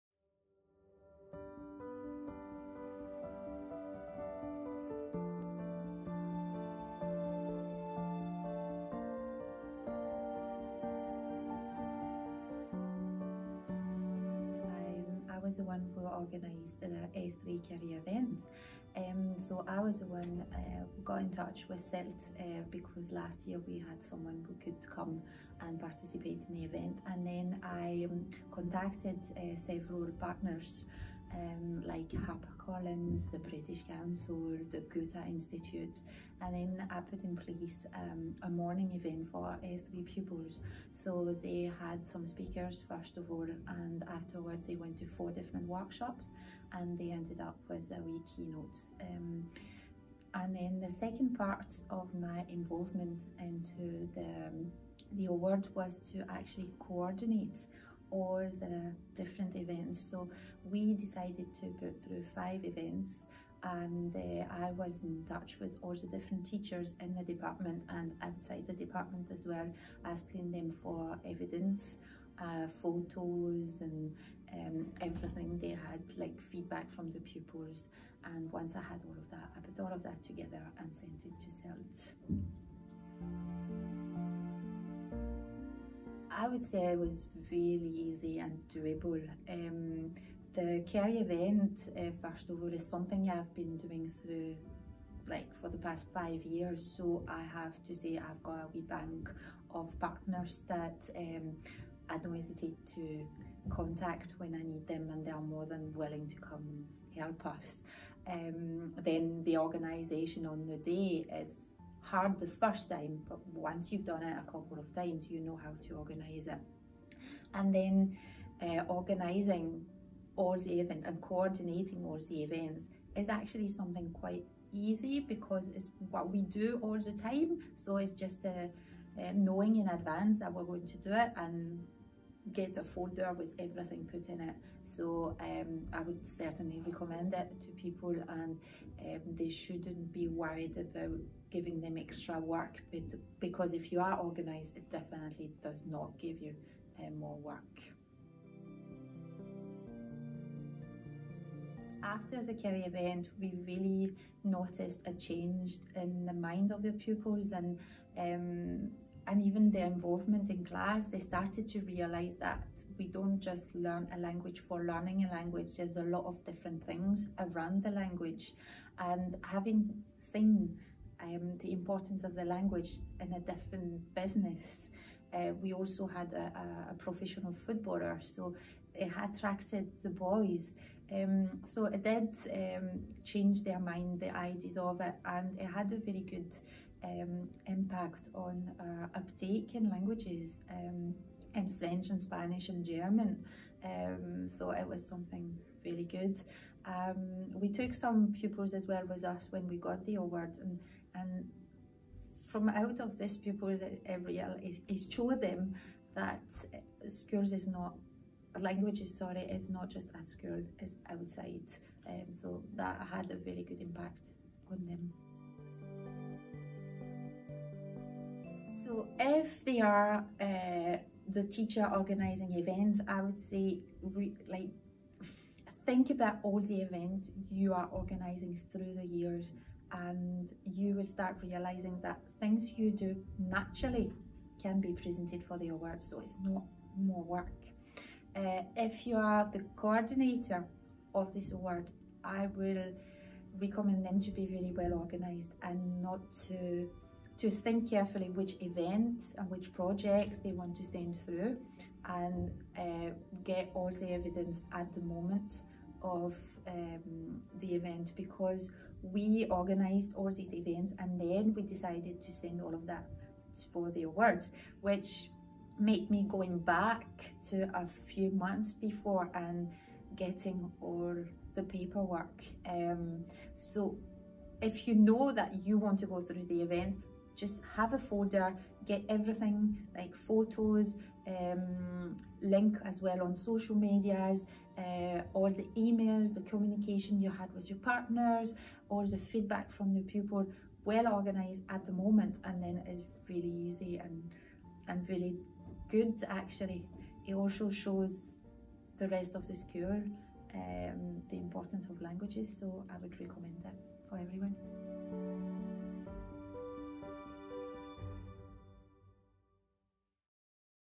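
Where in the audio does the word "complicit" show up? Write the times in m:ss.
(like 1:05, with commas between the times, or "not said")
not said.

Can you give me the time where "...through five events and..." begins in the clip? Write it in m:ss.
1:02.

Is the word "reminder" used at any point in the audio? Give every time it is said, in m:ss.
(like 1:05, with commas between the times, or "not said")
not said.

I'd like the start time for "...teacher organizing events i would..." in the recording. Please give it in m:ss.
3:41.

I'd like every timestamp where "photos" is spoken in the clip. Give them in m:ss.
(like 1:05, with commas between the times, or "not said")
1:12, 4:40.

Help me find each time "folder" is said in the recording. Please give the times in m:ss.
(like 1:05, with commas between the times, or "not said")
2:12, 4:37.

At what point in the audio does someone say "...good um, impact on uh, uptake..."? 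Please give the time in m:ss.
3:06.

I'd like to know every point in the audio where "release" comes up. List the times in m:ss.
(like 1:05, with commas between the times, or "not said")
not said.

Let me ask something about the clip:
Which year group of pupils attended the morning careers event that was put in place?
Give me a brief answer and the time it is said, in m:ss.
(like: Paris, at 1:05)
S3, at 0:39.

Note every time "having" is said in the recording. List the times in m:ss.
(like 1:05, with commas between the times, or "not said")
2:49.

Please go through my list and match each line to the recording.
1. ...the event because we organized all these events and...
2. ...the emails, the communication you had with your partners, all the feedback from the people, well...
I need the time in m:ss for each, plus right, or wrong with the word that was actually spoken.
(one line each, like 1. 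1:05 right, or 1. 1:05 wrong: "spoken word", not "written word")
1. 4:17 right
2. 4:45 right.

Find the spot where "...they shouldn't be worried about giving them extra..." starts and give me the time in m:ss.
2:19.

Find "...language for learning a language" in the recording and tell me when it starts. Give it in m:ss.
2:44.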